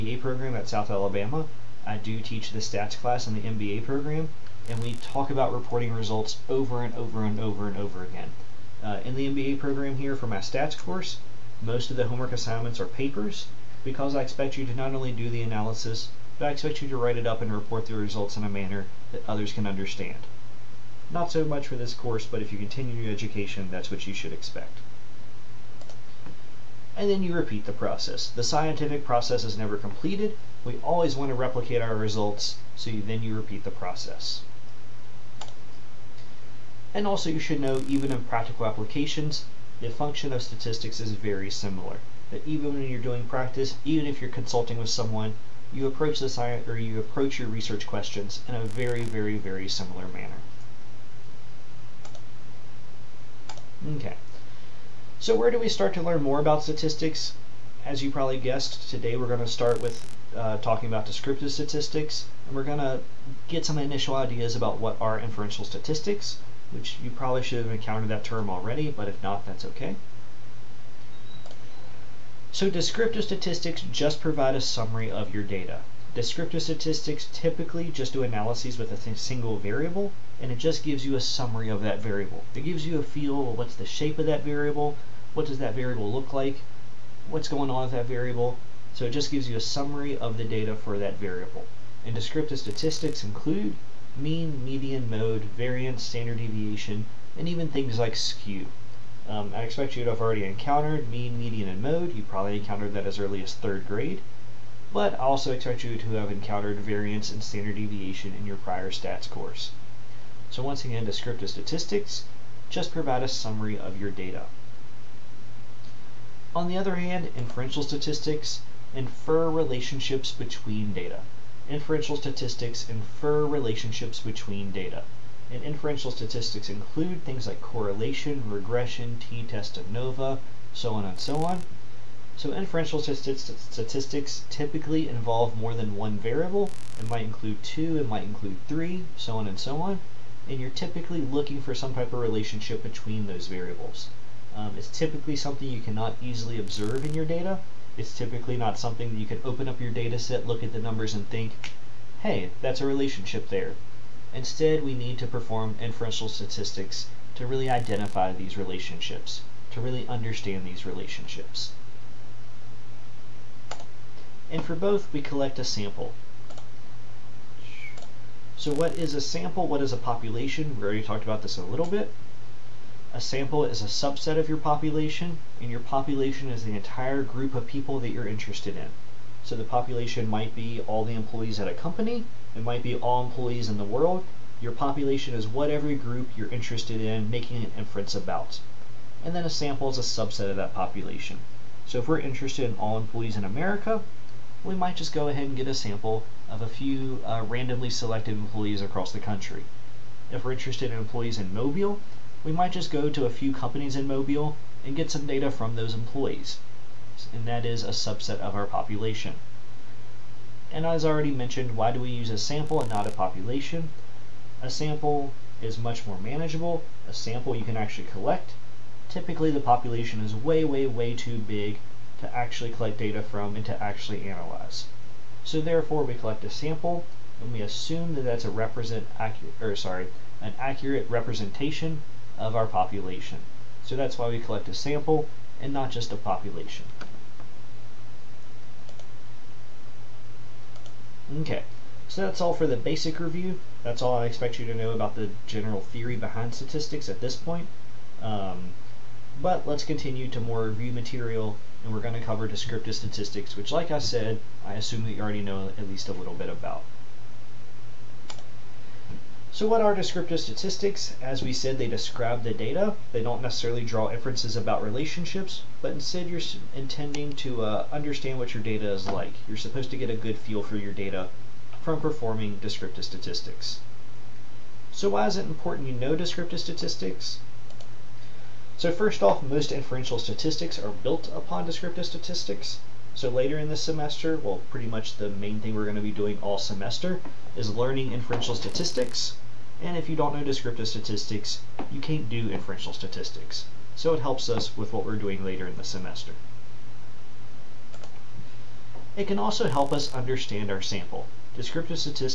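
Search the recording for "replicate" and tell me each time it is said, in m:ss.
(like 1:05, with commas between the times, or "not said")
0:31.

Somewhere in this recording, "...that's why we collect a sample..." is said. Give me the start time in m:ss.
3:53.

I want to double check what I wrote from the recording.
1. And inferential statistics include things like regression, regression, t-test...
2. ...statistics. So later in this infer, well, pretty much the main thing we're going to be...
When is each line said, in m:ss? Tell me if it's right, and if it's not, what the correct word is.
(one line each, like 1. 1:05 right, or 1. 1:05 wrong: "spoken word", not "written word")
1. 2:05 wrong: "correlation", not "regression"
2. 4:42 wrong: "semester", not "infer".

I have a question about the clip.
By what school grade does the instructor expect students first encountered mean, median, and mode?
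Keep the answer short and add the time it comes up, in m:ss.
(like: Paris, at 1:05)
Third grade, at 1:43.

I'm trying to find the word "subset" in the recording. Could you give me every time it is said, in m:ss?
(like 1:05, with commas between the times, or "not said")
2:53, 3:10, 3:27.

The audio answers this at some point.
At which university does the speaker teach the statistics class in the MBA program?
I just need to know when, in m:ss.
0:00.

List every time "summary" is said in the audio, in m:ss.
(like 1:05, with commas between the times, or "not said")
1:14, 1:21, 1:29, 1:53.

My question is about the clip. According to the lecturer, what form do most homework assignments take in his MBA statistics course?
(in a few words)
Papers.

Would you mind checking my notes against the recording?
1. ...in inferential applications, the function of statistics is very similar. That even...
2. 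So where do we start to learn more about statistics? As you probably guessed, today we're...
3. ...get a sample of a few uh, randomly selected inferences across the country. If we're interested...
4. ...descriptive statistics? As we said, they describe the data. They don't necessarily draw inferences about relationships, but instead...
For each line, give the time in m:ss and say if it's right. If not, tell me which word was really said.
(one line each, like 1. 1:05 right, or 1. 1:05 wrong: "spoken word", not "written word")
1. 0:38 wrong: "practical", not "inferential"
2. 0:55 right
3. 3:15 wrong: "employees", not "inferences"
4. 4:19 right.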